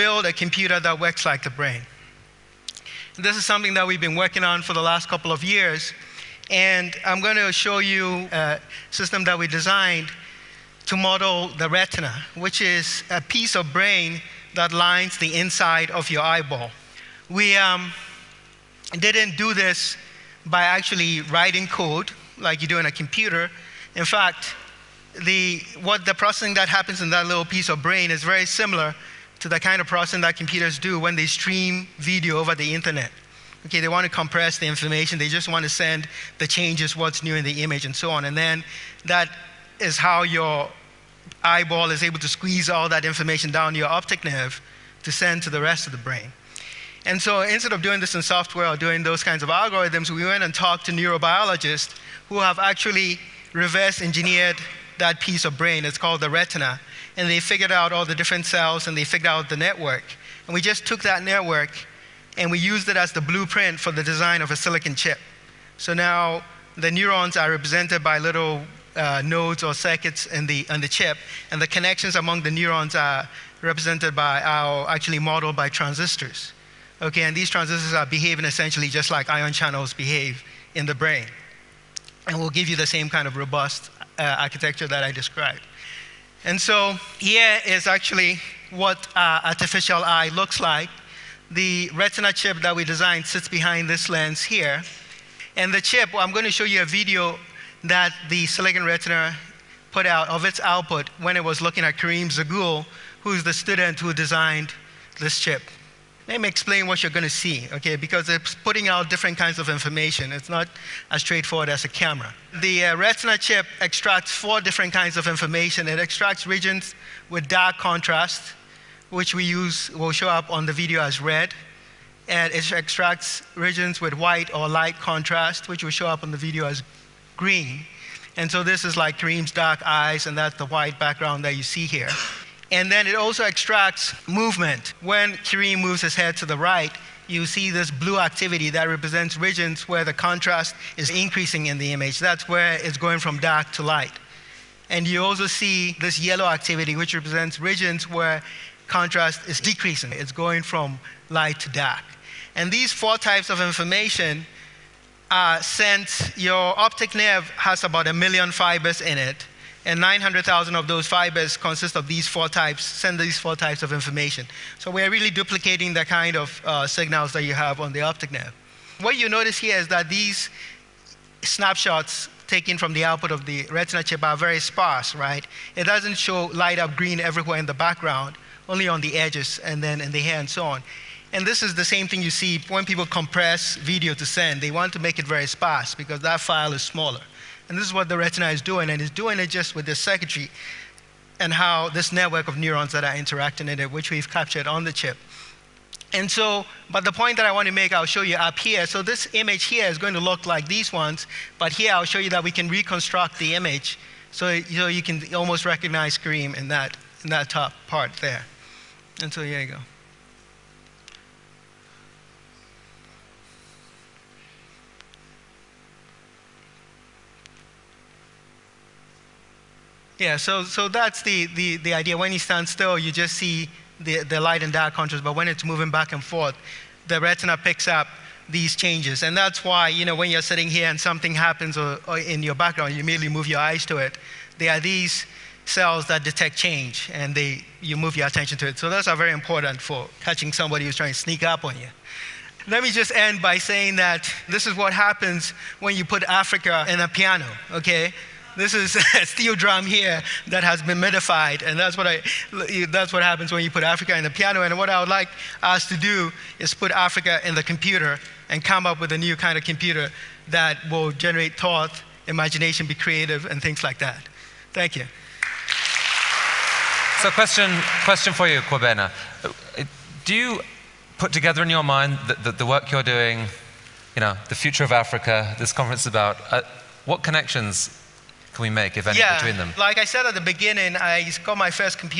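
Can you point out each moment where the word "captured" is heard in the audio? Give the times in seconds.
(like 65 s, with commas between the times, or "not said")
194 s.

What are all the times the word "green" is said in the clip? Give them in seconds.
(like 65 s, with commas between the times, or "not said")
127 s, 176 s.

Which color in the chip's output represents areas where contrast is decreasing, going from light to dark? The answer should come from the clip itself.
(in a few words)
yellow.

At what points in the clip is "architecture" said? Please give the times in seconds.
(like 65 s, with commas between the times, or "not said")
84 s.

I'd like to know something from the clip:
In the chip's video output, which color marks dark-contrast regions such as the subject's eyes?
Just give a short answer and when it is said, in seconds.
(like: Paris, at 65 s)
red, at 121 s.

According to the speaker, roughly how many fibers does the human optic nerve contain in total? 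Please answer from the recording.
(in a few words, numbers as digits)
1 million.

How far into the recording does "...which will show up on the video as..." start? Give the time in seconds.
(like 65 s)
125 s.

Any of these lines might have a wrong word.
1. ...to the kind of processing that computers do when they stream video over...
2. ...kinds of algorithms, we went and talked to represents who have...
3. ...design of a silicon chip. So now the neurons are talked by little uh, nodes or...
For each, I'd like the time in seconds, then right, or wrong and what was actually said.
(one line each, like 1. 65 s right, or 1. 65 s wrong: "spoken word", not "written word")
1. 29 s right
2. 49 s wrong: "neurobiologists", not "represents"
3. 64 s wrong: "represented", not "talked".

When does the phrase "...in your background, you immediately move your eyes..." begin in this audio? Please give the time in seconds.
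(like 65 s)
232 s.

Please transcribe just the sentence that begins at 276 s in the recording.
Uh, what connections can we make, if any, yeah, between them?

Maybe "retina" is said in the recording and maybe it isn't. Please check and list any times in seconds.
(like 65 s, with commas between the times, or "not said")
11 s, 56 s, 91 s, 98 s, 112 s, 173 s, 188 s, 227 s.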